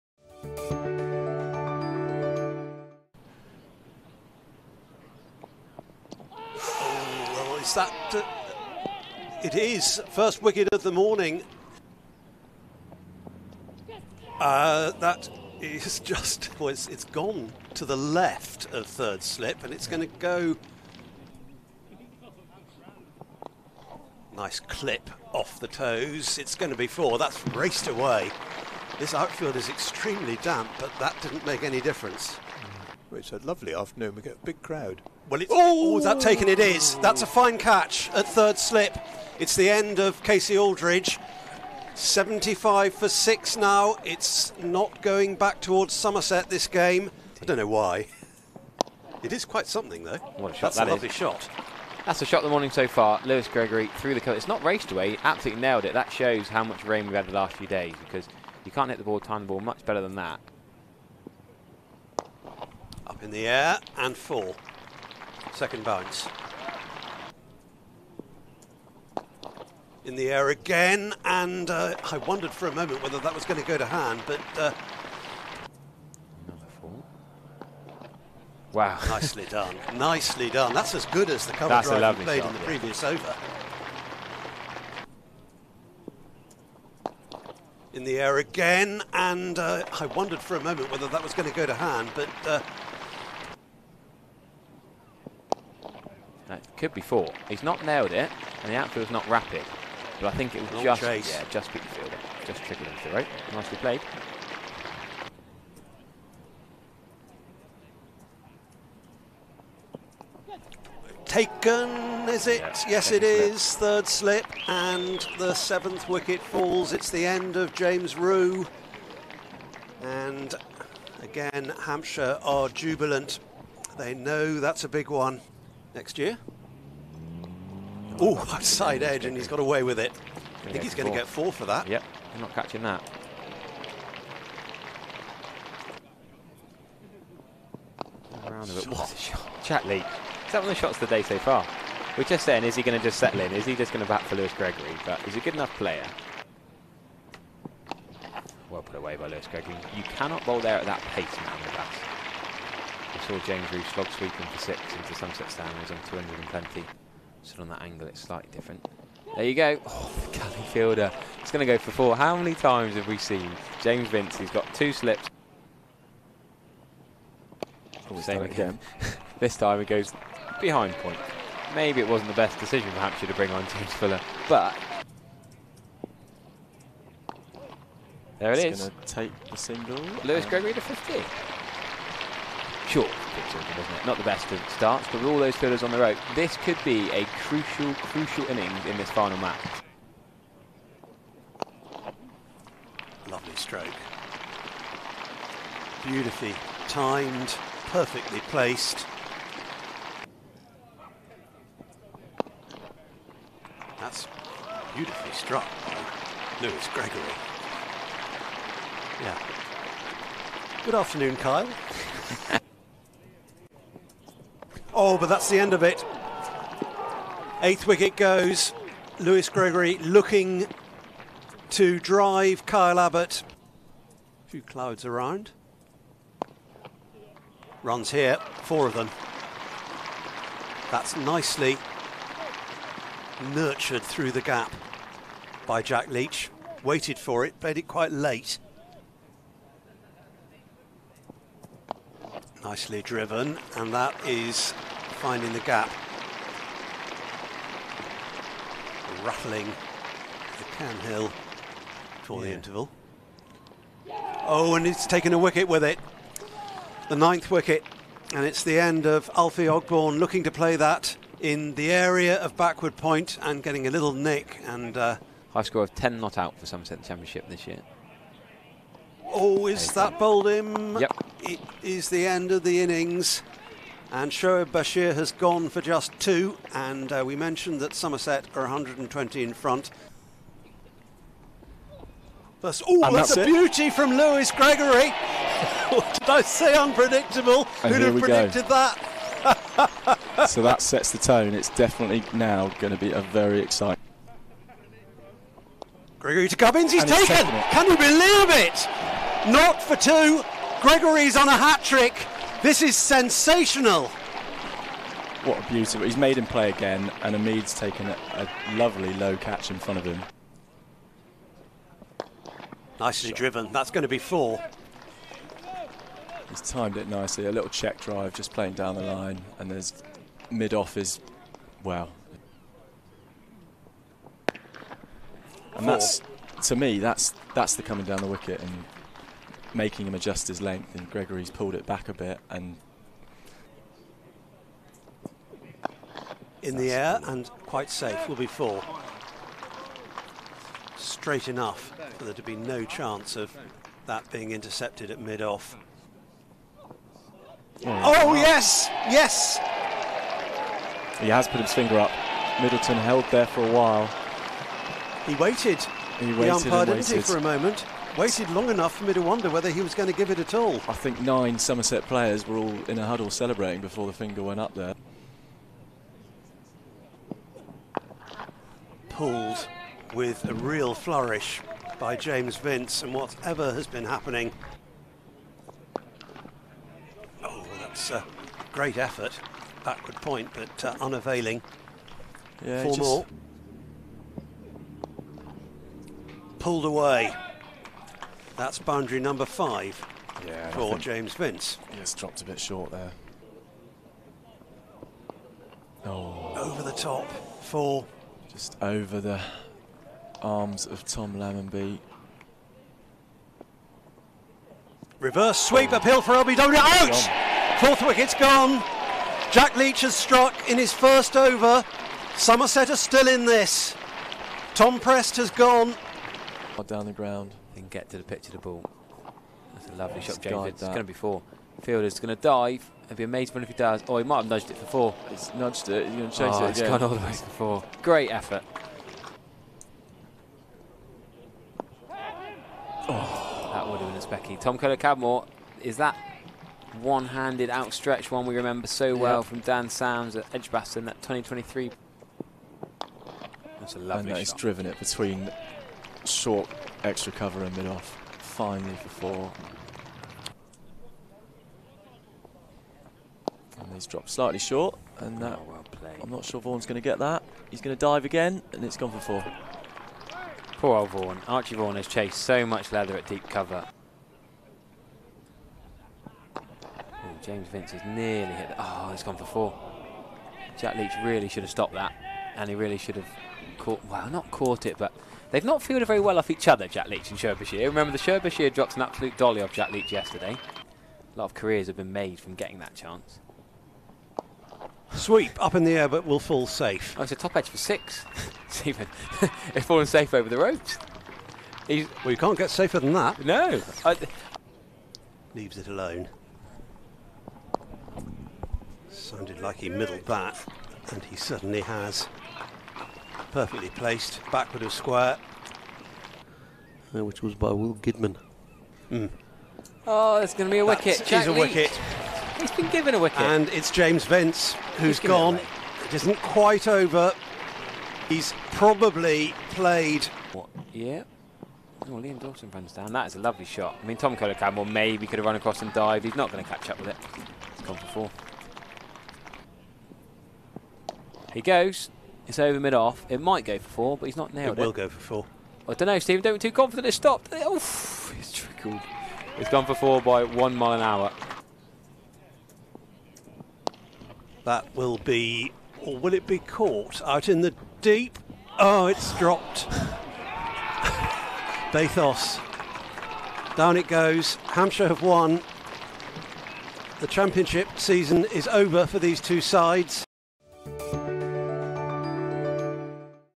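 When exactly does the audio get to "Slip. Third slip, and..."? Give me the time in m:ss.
1:53.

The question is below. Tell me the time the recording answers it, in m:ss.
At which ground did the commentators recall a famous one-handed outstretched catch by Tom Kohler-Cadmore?
7:20.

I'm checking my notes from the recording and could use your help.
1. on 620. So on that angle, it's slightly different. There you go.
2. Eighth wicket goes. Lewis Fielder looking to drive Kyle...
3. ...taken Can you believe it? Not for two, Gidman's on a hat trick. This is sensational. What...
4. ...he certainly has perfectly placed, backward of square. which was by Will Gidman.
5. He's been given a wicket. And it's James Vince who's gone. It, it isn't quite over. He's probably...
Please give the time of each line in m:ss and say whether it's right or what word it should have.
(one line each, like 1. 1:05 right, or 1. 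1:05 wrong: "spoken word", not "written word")
1. 2:35 wrong: "220", not "620"
2. 3:37 wrong: "Gregory", not "Fielder"
3. 4:57 wrong: "Gregory", not "Gidman"
4. 8:21 right
5. 8:32 right.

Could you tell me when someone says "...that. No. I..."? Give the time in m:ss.
8:13.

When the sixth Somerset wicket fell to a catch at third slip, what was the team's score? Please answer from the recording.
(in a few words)
75 for 6.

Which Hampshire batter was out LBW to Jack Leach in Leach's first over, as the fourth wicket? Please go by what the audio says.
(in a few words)
Tom Prest.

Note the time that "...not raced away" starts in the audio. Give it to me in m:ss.
0:54.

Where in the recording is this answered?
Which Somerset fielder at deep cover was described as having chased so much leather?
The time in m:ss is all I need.
7:41.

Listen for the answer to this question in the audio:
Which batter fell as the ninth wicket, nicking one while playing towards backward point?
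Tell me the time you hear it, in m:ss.
4:19.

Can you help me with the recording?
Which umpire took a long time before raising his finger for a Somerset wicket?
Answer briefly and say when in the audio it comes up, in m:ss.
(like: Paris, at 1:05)
Middleton, at 5:52.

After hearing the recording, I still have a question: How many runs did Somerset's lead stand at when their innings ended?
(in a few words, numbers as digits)
120.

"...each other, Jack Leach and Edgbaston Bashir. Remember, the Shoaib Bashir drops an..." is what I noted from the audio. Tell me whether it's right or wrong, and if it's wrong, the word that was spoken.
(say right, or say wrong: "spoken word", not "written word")
wrong: "Shoaib", not "Edgbaston".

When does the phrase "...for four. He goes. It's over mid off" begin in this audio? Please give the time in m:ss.
8:47.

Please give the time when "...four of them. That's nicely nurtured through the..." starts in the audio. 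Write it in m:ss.
3:48.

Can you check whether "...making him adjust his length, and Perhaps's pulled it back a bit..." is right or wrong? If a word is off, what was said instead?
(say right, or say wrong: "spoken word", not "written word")
wrong: "Gregory", not "Perhaps".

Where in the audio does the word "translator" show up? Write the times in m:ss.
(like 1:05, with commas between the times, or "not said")
not said.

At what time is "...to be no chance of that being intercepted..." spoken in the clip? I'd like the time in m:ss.
5:42.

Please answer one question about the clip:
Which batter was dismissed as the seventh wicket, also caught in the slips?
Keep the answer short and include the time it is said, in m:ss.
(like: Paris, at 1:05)
James Rew, at 1:57.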